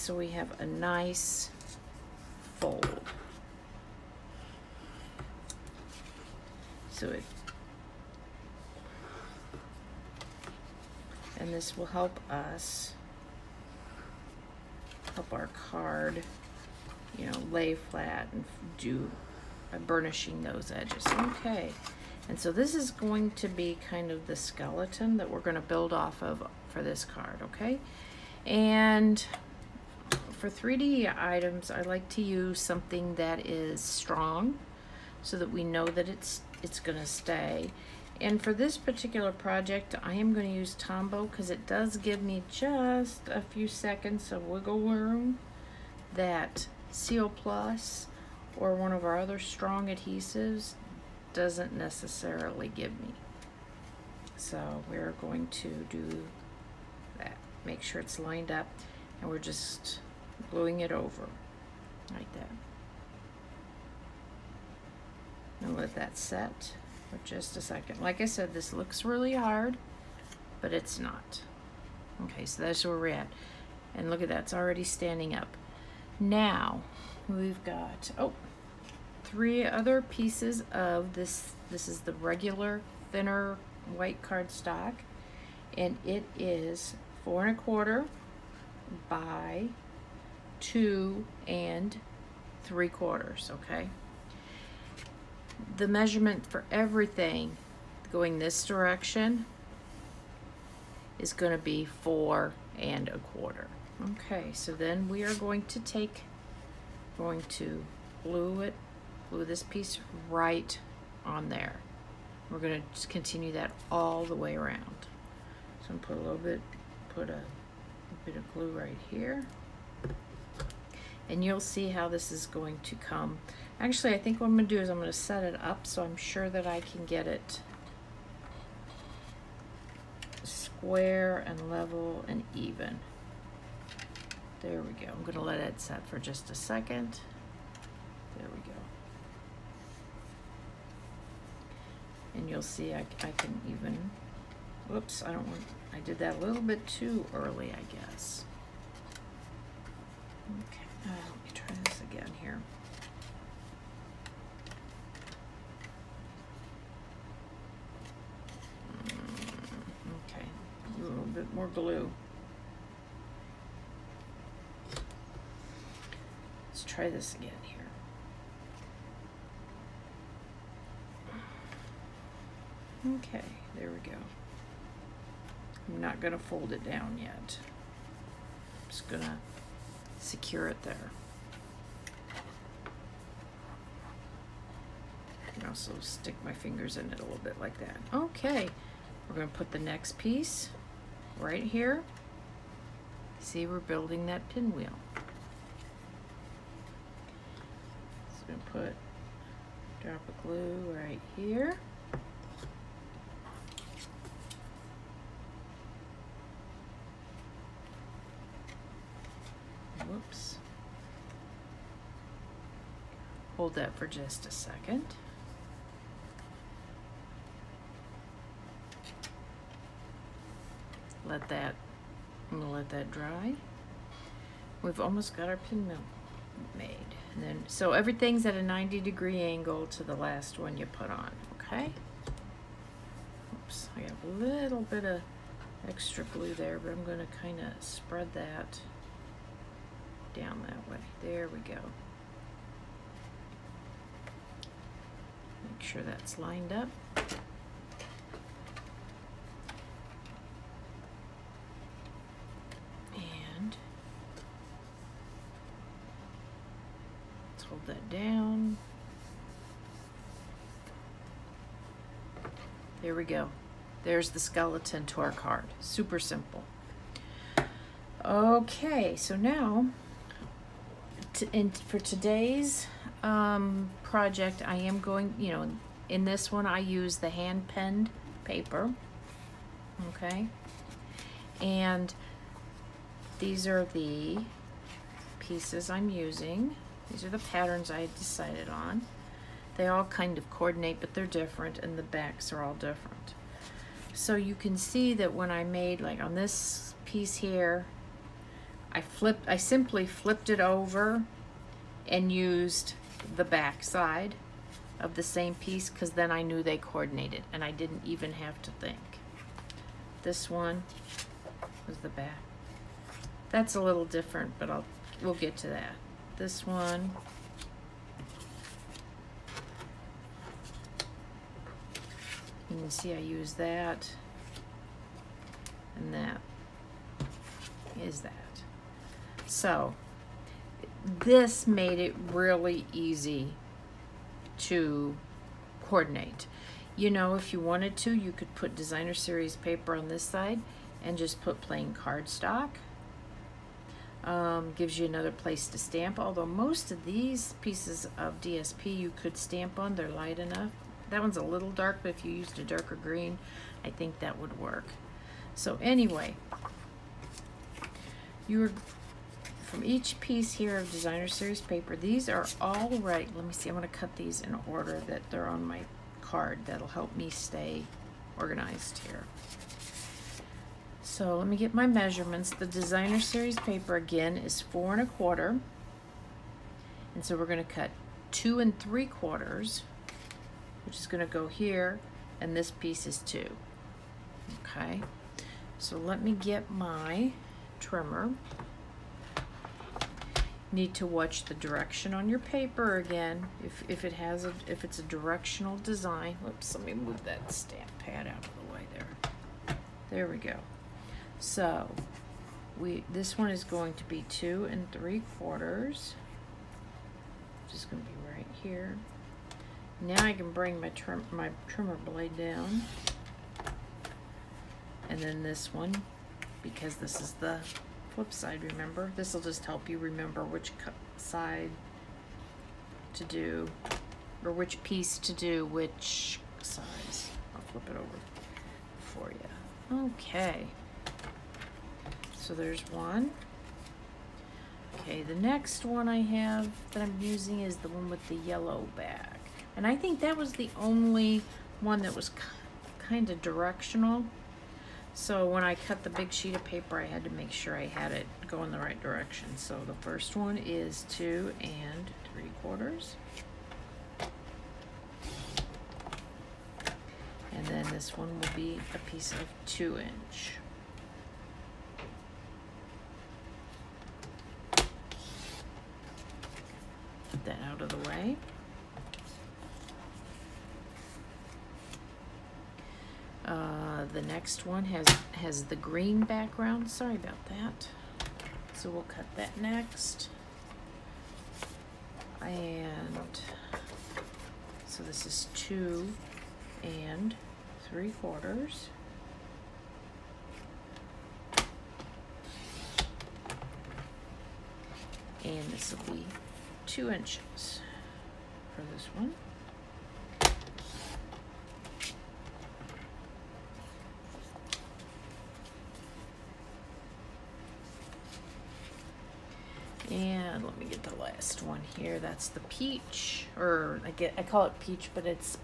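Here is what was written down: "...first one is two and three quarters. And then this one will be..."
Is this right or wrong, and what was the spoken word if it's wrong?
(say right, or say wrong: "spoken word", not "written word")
right.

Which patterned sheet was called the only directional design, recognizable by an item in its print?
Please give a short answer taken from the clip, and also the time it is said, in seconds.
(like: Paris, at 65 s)
the yellow bag, at 438 s.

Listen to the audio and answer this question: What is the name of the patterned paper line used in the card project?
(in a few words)
hand penned paper.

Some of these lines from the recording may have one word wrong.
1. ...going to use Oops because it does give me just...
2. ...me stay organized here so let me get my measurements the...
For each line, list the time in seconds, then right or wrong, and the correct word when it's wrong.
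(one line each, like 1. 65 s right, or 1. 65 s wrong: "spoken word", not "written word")
1. 40 s wrong: "Tombow", not "Oops"
2. 367 s right.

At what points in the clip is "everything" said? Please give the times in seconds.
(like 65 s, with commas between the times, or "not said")
96 s, 227 s.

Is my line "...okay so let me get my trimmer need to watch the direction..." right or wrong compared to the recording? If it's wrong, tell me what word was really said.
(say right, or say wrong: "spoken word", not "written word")
right.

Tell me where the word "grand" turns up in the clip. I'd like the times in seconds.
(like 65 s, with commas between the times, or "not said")
not said.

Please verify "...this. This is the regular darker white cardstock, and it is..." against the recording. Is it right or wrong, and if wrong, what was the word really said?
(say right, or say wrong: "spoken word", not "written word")
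wrong: "thinner", not "darker".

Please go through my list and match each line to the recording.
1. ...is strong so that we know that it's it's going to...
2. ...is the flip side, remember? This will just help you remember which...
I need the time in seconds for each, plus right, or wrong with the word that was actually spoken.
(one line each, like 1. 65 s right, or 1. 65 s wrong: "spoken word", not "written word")
1. 33 s right
2. 417 s right.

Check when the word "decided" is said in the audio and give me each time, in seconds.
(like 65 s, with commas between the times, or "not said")
288 s.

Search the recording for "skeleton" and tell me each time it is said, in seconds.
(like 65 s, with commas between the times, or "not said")
24 s, 264 s.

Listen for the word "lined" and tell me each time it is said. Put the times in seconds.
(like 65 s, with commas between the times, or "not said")
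58 s, 246 s.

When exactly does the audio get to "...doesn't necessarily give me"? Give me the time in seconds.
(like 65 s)
51 s.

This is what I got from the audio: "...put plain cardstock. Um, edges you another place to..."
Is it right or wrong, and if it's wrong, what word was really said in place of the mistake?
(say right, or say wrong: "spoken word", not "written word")
wrong: "gives", not "edges".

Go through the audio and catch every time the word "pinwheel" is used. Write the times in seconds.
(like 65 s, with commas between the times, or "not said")
194 s, 225 s.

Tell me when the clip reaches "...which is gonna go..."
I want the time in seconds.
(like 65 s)
380 s.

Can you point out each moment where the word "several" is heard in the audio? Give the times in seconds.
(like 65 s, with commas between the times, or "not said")
not said.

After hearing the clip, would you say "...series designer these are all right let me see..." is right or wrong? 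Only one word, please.
wrong.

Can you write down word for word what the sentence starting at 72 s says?
Okay, so that's where we're at.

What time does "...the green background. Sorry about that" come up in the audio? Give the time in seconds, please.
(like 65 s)
475 s.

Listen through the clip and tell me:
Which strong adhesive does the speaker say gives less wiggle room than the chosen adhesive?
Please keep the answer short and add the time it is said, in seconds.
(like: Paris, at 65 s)
Seal Plus, at 46 s.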